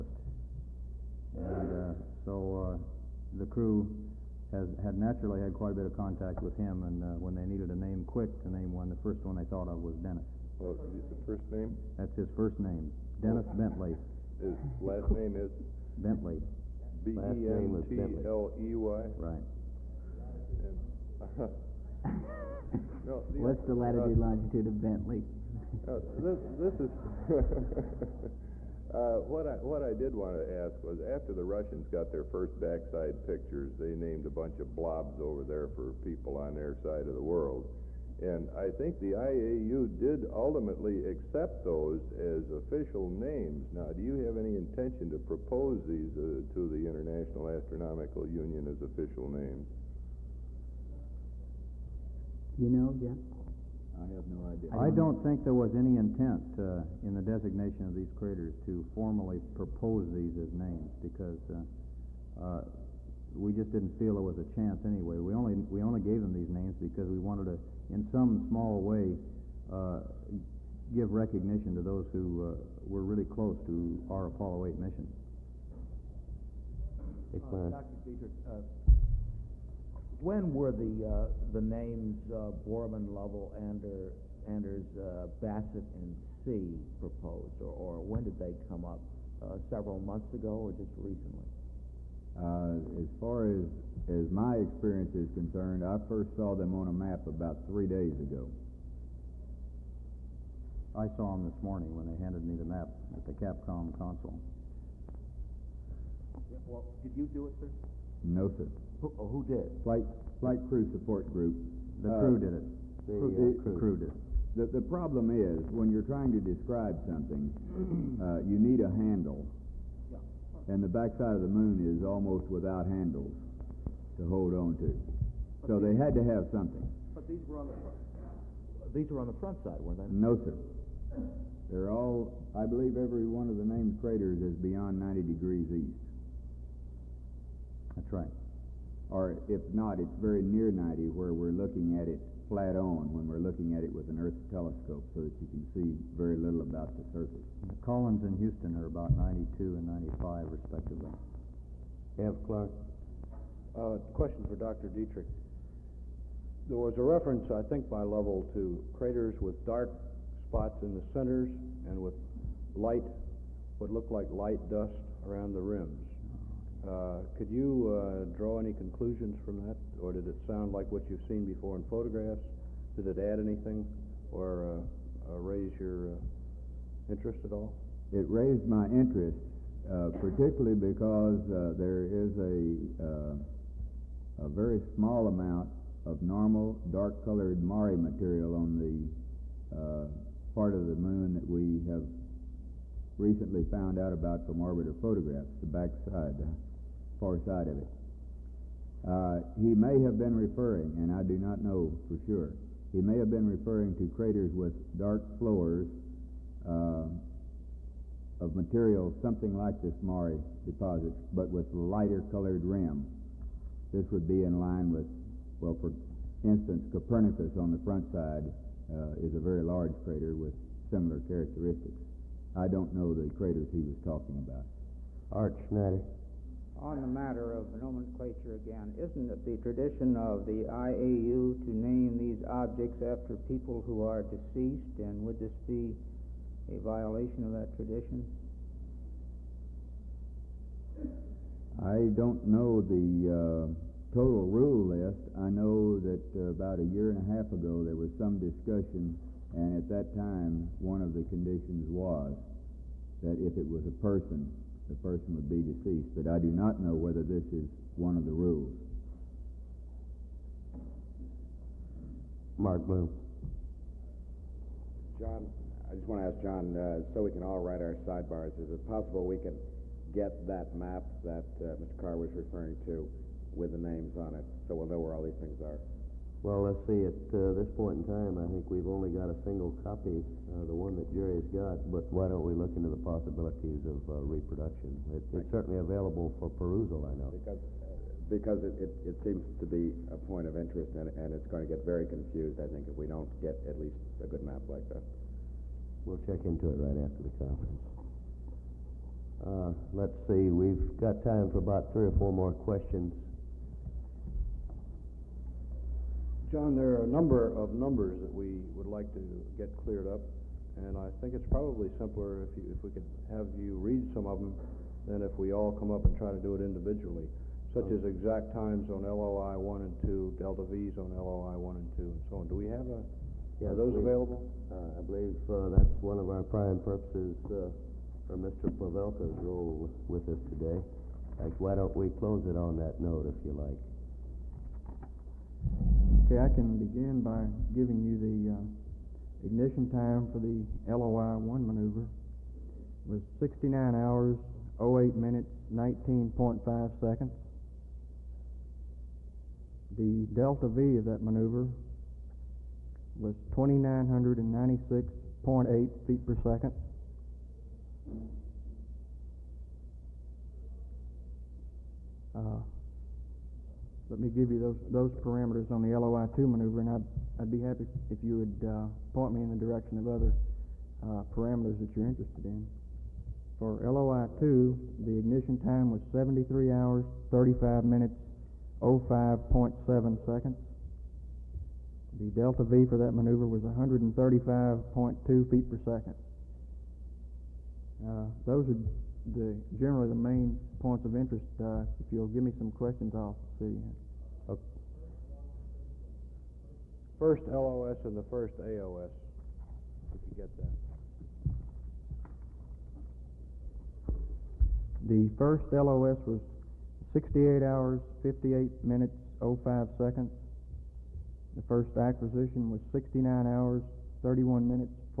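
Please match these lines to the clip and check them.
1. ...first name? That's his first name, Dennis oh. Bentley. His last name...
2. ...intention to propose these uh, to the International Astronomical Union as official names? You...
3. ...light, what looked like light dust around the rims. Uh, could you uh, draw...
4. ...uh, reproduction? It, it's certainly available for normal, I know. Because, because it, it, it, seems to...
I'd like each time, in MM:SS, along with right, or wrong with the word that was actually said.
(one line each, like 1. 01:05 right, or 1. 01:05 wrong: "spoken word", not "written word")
1. 00:11 right
2. 00:44 right
3. 02:42 right
4. 04:44 wrong: "perusal", not "normal".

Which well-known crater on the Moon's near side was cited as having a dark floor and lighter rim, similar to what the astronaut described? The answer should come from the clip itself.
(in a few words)
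Copernicus.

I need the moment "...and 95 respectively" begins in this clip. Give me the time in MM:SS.
02:29.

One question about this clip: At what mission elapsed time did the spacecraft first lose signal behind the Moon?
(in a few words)
68 hours, 58 minutes, 05 seconds.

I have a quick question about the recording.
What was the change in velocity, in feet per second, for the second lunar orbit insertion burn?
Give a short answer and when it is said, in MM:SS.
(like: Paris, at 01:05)
135.2 feet per second, at 06:23.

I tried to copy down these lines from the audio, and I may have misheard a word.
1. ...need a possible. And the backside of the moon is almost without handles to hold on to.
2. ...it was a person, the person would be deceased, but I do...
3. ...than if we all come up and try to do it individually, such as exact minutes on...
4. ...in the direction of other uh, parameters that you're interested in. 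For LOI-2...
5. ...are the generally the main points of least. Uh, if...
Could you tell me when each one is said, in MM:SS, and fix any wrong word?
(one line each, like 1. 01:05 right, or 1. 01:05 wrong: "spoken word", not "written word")
1. 01:58 wrong: "handle", not "possible"
2. 04:13 right
3. 05:15 wrong: "times", not "minutes"
4. 06:09 right
5. 06:28 wrong: "interest", not "least".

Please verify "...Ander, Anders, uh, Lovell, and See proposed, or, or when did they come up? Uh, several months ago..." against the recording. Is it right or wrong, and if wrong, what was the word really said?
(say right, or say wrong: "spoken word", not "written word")
wrong: "Bassett", not "Lovell".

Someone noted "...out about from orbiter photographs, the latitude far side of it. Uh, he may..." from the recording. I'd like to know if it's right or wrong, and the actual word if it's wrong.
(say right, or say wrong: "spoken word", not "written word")
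wrong: "backside", not "latitude".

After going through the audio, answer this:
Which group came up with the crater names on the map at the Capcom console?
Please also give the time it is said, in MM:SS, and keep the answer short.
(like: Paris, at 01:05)
Flight crew support group, at 01:49.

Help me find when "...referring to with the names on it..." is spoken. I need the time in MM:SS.
04:32.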